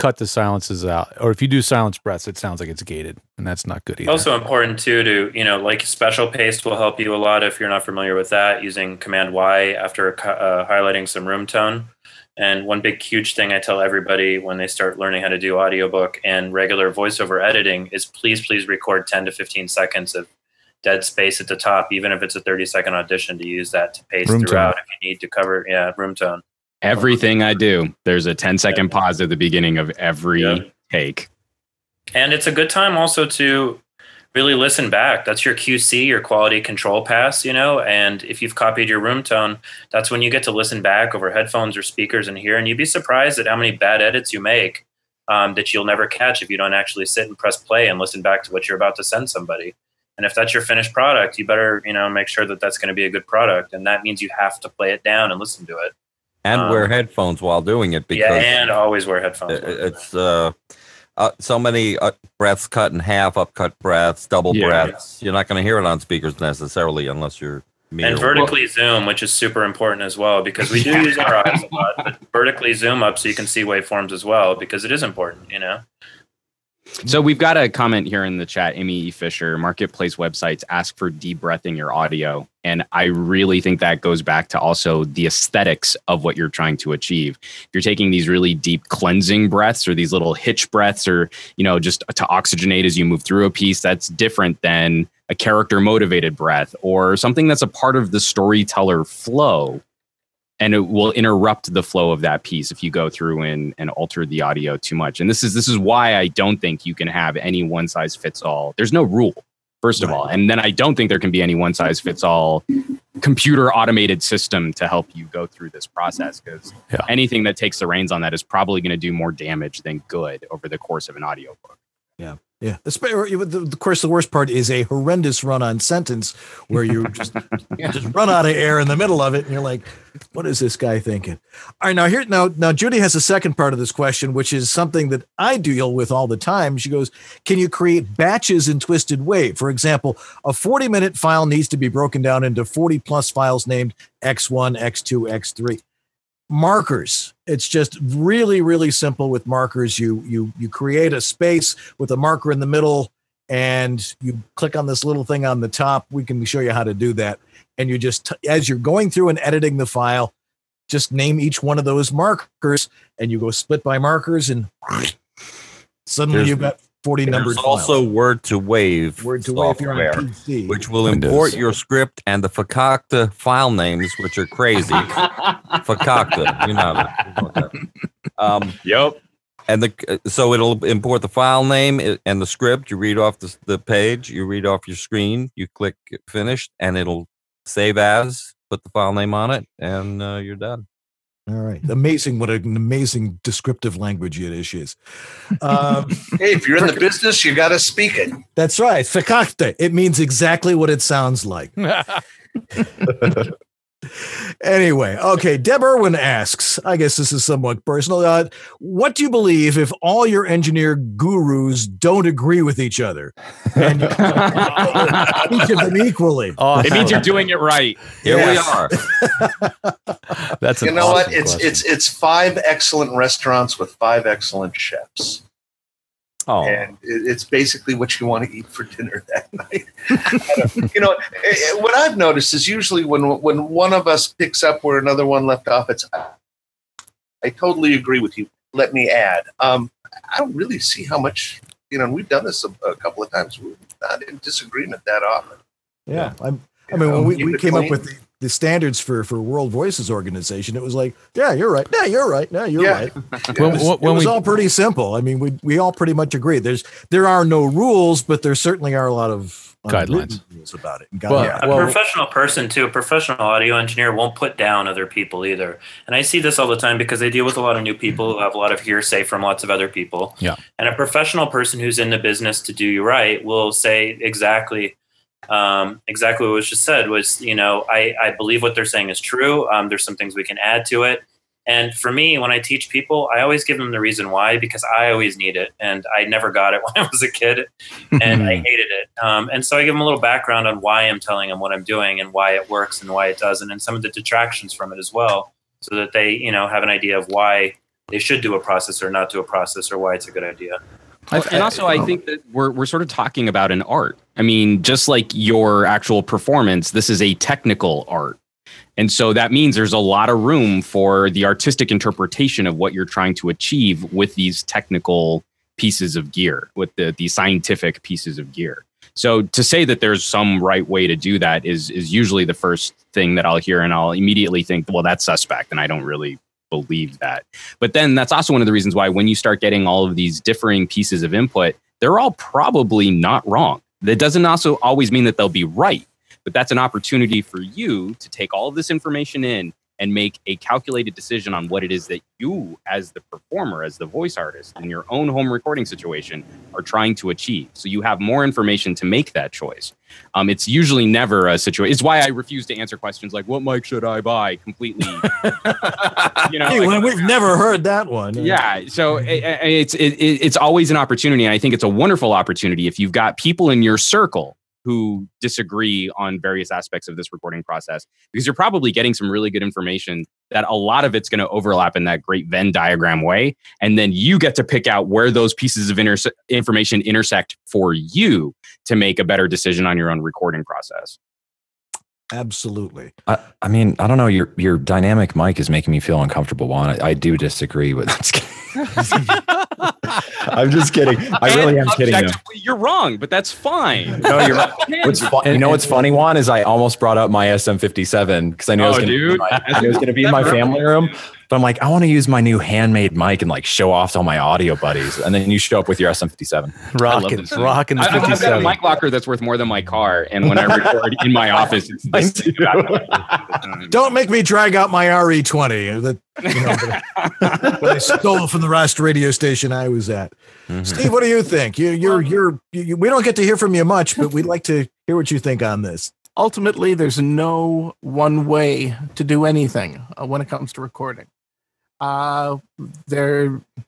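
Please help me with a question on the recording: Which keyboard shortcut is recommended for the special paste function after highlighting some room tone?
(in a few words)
Command Y.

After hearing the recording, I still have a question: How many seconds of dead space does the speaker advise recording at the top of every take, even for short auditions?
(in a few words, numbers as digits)
10 to 15 seconds.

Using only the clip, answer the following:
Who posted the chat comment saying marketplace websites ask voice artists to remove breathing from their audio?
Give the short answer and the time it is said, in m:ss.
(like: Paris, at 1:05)
Amy E. Fisher, at 1:18.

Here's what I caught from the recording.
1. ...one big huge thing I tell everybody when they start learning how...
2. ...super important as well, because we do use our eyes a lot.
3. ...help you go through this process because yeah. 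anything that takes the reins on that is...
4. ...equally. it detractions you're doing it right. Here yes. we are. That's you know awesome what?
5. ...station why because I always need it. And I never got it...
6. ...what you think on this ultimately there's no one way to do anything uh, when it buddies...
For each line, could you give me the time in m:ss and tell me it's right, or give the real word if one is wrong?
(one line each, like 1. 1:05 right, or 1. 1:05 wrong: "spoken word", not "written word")
1. 0:12 right
2. 1:09 right
3. 1:54 right
4. 3:35 wrong: "means", not "detractions"
5. 4:43 wrong: "reason", not "station"
6. 7:05 wrong: "comes", not "buddies".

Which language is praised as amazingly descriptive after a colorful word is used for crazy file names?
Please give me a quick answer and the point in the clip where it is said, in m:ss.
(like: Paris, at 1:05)
Yiddish, at 3:14.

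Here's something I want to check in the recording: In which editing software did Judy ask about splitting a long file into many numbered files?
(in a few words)
Twisted Wave.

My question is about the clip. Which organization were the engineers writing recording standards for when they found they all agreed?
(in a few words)
World Voices.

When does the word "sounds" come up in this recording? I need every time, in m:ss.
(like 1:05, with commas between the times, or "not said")
0:02, 3:21.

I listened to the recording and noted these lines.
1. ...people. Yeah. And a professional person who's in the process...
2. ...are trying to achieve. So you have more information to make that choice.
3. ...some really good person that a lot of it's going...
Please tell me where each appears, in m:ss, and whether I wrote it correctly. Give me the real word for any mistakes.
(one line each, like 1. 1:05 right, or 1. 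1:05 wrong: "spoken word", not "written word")
1. 4:29 wrong: "business", not "process"
2. 5:46 right
3. 6:09 wrong: "information", not "person".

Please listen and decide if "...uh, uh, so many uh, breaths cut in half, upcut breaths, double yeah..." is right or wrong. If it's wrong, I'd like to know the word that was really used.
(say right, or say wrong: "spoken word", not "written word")
right.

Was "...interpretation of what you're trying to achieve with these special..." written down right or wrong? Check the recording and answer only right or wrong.
wrong.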